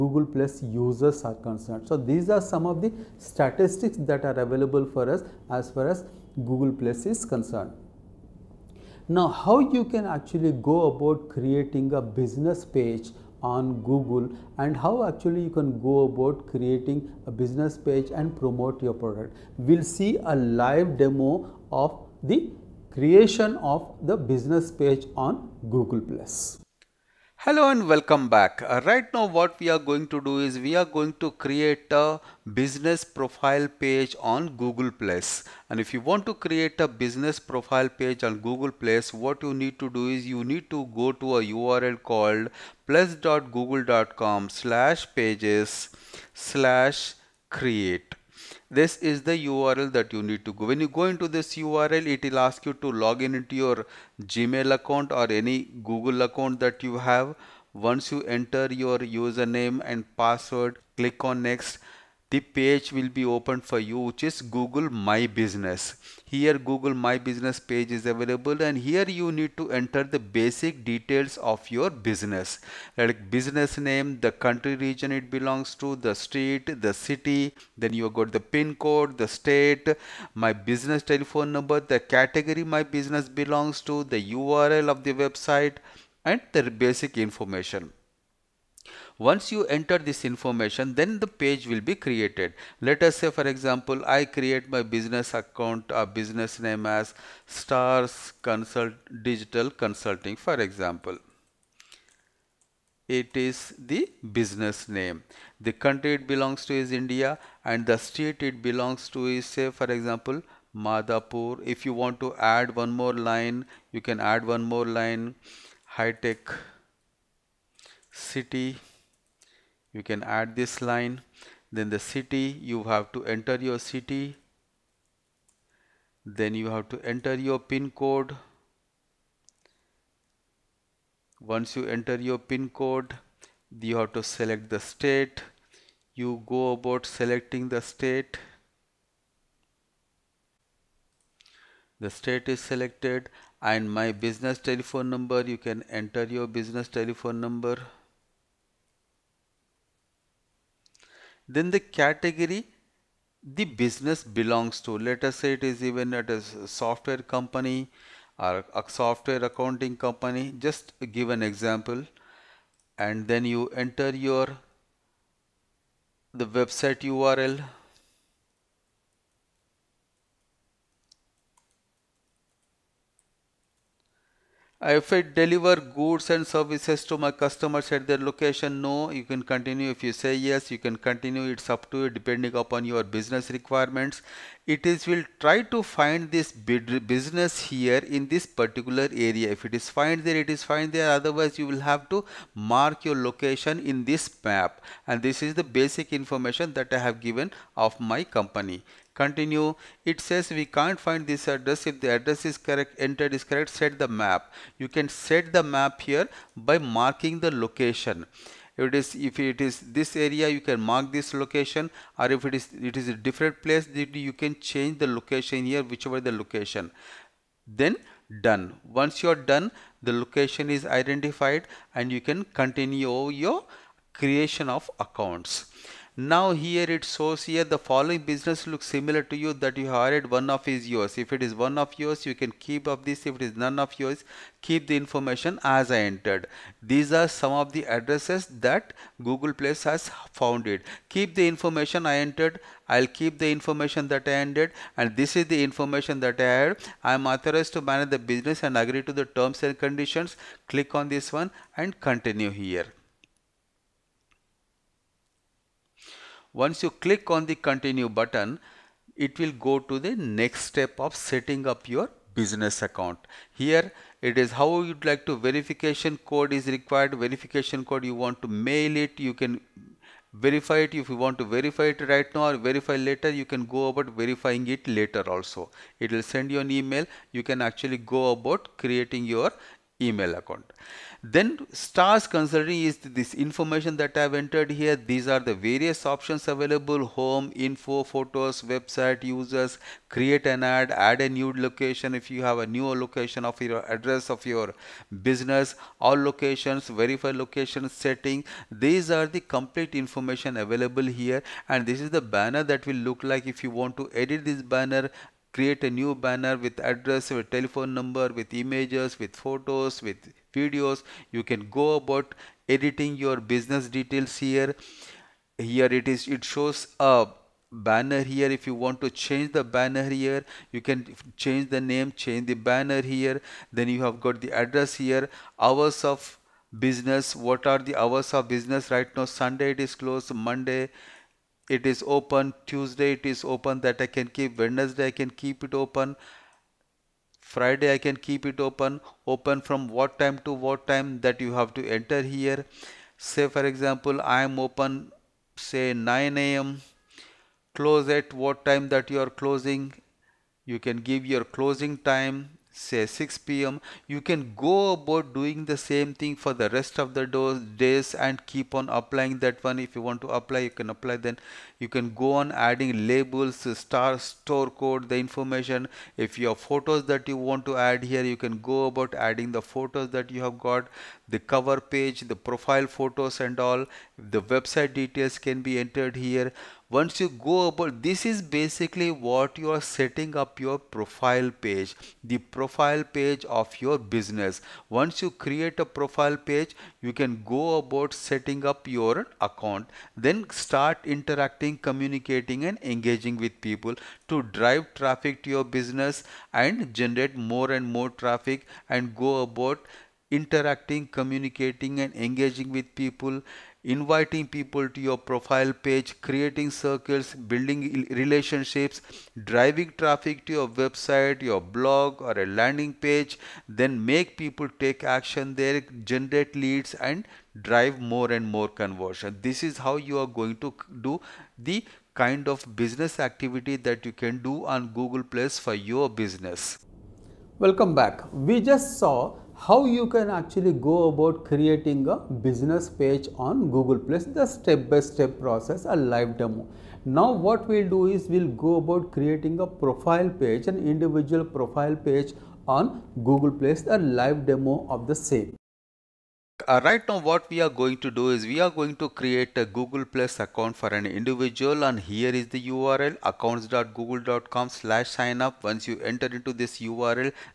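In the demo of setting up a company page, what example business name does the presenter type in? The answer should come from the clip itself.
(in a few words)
Stars Consult Digital Consulting.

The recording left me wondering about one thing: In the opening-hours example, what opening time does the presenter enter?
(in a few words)
9 a.m.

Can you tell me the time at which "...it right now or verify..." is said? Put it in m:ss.
4:31.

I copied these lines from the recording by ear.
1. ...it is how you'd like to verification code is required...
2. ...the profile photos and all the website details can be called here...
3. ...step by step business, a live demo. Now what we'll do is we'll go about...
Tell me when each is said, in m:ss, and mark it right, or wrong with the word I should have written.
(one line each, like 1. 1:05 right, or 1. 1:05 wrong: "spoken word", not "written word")
1. 4:24 right
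2. 6:12 wrong: "entered", not "called"
3. 7:14 wrong: "process", not "business".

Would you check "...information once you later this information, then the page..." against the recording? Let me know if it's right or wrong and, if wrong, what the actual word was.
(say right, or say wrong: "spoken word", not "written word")
wrong: "enter", not "later".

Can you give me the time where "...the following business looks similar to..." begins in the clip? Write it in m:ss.
3:47.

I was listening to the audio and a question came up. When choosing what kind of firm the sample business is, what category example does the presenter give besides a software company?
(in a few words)
software accounting company.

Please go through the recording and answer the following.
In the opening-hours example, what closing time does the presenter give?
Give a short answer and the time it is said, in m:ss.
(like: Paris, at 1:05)
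6 pm, at 5:53.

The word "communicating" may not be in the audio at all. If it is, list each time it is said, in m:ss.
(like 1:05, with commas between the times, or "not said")
6:31, 6:41.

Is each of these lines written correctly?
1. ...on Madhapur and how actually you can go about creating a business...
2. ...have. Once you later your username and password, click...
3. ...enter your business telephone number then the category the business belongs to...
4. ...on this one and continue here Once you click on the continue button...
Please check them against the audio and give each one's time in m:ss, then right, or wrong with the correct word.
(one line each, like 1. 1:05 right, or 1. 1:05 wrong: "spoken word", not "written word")
1. 0:13 wrong: "Google", not "Madhapur"
2. 0:56 wrong: "enter", not "later"
3. 2:26 right
4. 4:10 right.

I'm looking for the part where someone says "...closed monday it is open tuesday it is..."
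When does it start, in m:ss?
5:30.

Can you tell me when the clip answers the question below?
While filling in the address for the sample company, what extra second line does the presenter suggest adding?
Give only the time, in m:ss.
1:55.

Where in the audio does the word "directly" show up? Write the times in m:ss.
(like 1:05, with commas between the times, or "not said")
not said.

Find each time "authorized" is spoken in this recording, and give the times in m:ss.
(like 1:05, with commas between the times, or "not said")
4:07.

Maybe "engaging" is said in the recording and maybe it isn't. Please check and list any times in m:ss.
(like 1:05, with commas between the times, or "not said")
6:32, 6:42.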